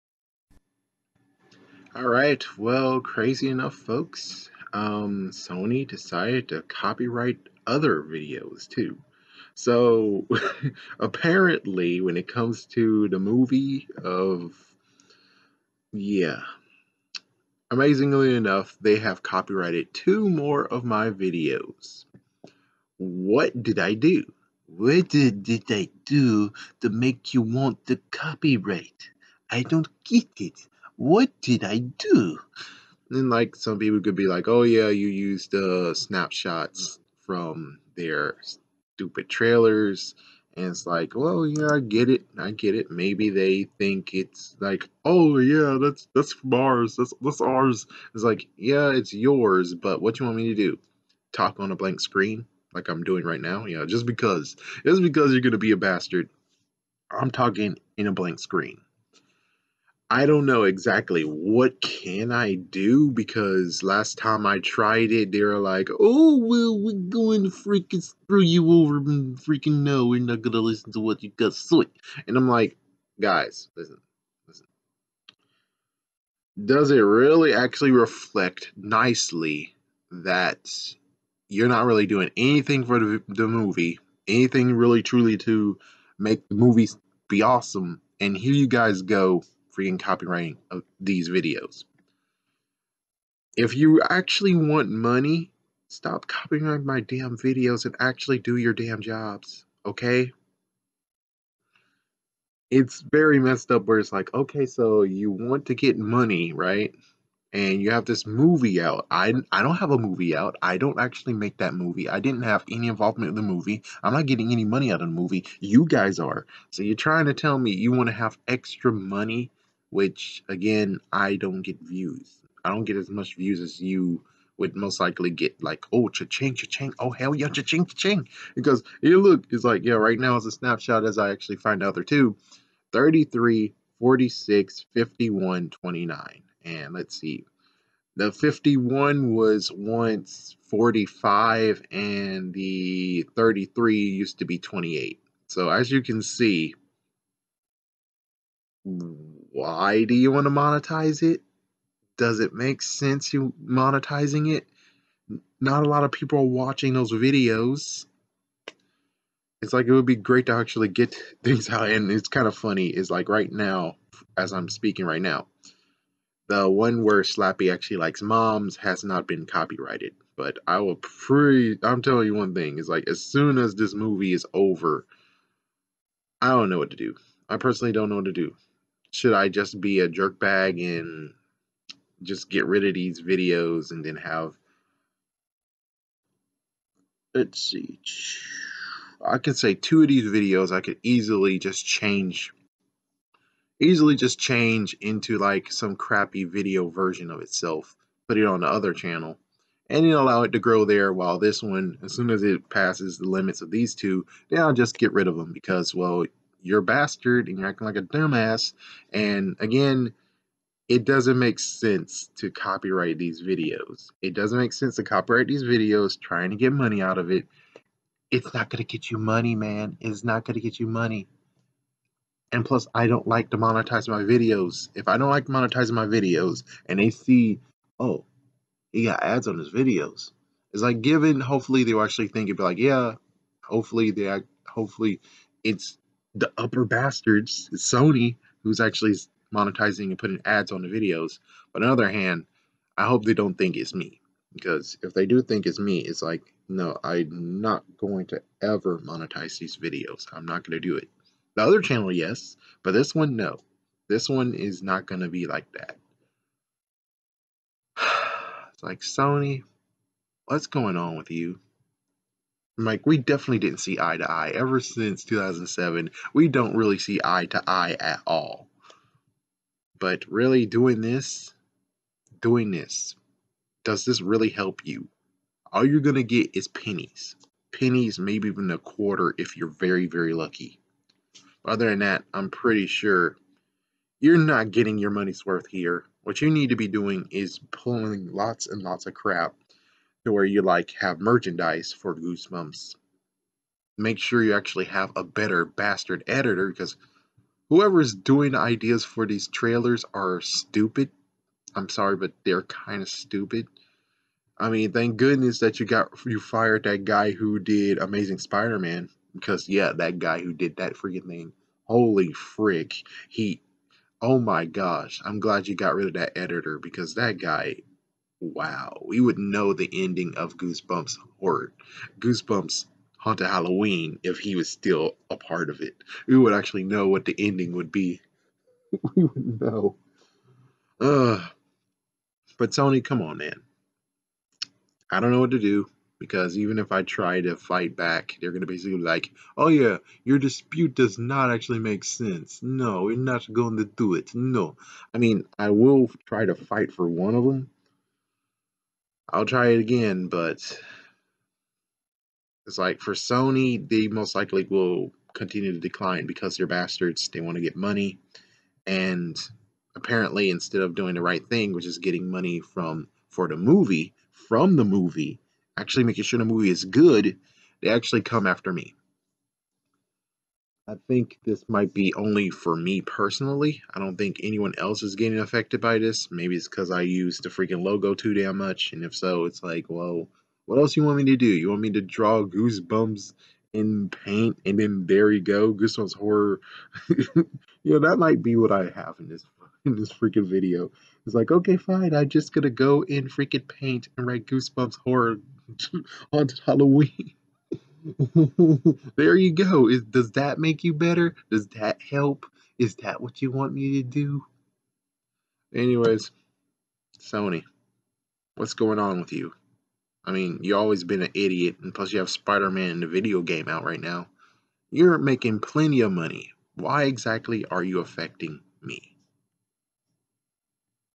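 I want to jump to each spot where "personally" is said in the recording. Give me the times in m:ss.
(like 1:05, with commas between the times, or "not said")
2:57, 6:12.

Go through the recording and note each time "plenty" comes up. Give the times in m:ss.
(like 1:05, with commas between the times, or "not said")
6:55.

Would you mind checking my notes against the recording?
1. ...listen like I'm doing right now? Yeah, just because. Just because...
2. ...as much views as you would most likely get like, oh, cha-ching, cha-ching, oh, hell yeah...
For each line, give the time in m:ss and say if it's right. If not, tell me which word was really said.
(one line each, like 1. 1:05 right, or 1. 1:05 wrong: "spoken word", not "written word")
1. 0:51 wrong: "screen", not "listen"
2. 2:02 right.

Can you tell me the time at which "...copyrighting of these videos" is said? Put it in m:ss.
1:29.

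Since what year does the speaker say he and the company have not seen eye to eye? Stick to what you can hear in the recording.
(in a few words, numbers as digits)
2007.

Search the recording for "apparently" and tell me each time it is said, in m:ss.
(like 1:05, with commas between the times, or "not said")
0:11, 5:59.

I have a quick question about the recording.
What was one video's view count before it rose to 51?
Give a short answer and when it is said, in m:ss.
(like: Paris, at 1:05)
45, at 2:20.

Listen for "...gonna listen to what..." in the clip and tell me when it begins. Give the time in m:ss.
1:10.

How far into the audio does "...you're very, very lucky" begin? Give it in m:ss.
4:39.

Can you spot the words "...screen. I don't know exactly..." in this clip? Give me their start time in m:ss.
0:58.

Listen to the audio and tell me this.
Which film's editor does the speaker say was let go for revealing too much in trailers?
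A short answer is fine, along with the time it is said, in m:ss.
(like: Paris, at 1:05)
Amazing Spider-Man, at 5:07.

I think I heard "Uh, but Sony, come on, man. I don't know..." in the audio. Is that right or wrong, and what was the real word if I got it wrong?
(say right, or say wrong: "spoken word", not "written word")
right.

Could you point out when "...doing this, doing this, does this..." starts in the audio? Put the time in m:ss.
4:30.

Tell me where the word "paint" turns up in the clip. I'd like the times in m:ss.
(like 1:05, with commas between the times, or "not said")
6:24, 6:33.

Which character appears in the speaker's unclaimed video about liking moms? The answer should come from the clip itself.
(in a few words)
Slappy.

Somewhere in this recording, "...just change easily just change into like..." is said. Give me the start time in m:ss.
3:11.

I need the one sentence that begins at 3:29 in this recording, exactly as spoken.
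And again, it doesn't make sense to copyright these videos.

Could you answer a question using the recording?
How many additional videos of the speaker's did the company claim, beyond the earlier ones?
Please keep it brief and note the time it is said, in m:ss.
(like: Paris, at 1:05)
2, at 0:19.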